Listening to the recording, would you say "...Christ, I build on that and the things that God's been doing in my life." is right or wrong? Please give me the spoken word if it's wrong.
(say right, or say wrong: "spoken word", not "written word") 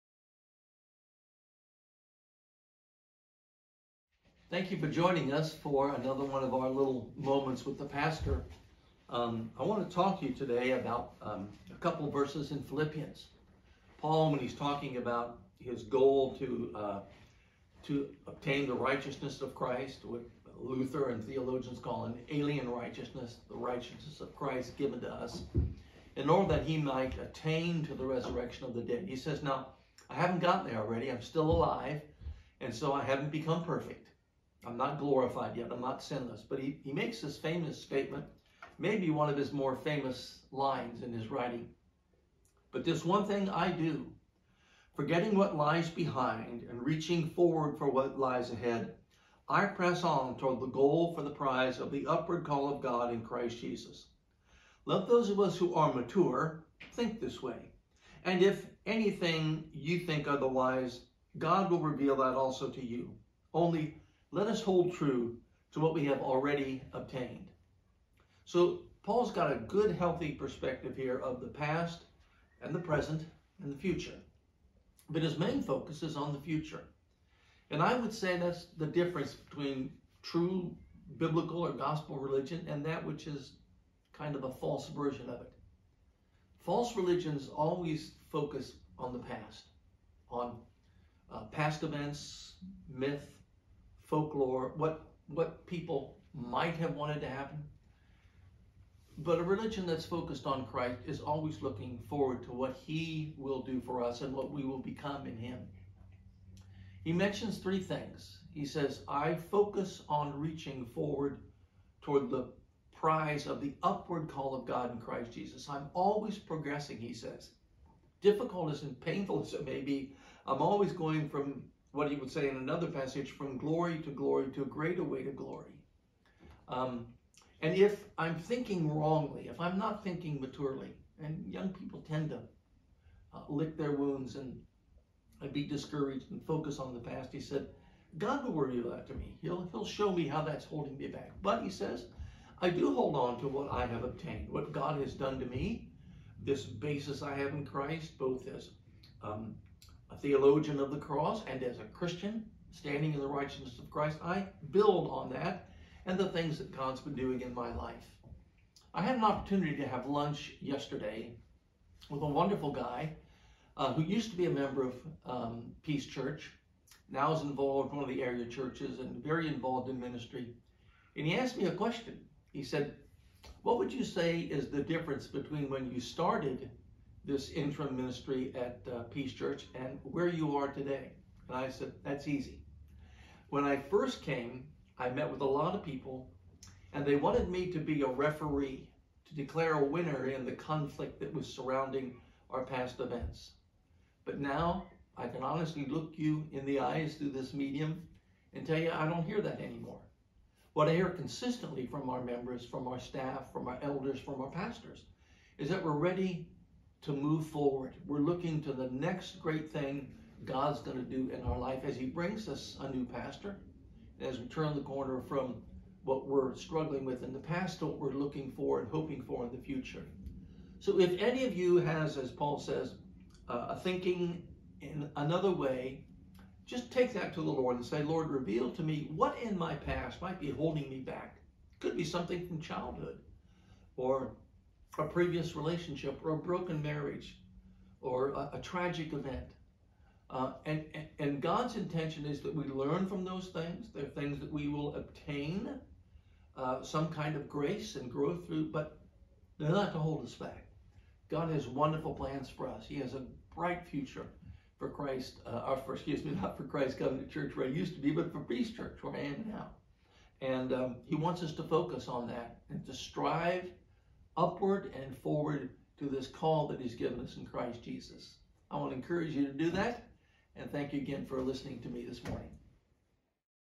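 right.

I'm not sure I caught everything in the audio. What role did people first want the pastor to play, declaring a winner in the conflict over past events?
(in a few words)
A referee.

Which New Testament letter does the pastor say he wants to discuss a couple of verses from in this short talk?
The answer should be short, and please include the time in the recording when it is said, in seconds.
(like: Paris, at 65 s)
Philippians, at 12 s.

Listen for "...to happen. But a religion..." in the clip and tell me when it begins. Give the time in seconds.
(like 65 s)
97 s.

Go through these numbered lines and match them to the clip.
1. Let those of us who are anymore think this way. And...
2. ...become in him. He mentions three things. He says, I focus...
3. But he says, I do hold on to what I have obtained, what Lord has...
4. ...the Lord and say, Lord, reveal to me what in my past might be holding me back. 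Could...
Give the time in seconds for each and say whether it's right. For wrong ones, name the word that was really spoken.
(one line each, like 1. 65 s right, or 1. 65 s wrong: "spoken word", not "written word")
1. 54 s wrong: "mature", not "anymore"
2. 104 s right
3. 141 s wrong: "God", not "Lord"
4. 227 s right.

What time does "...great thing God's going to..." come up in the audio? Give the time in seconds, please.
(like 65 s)
209 s.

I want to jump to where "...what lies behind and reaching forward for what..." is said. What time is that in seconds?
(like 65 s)
45 s.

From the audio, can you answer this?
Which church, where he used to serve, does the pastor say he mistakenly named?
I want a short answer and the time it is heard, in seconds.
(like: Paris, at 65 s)
Christ Covenant Church, at 256 s.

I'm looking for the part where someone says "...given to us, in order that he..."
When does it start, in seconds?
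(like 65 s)
24 s.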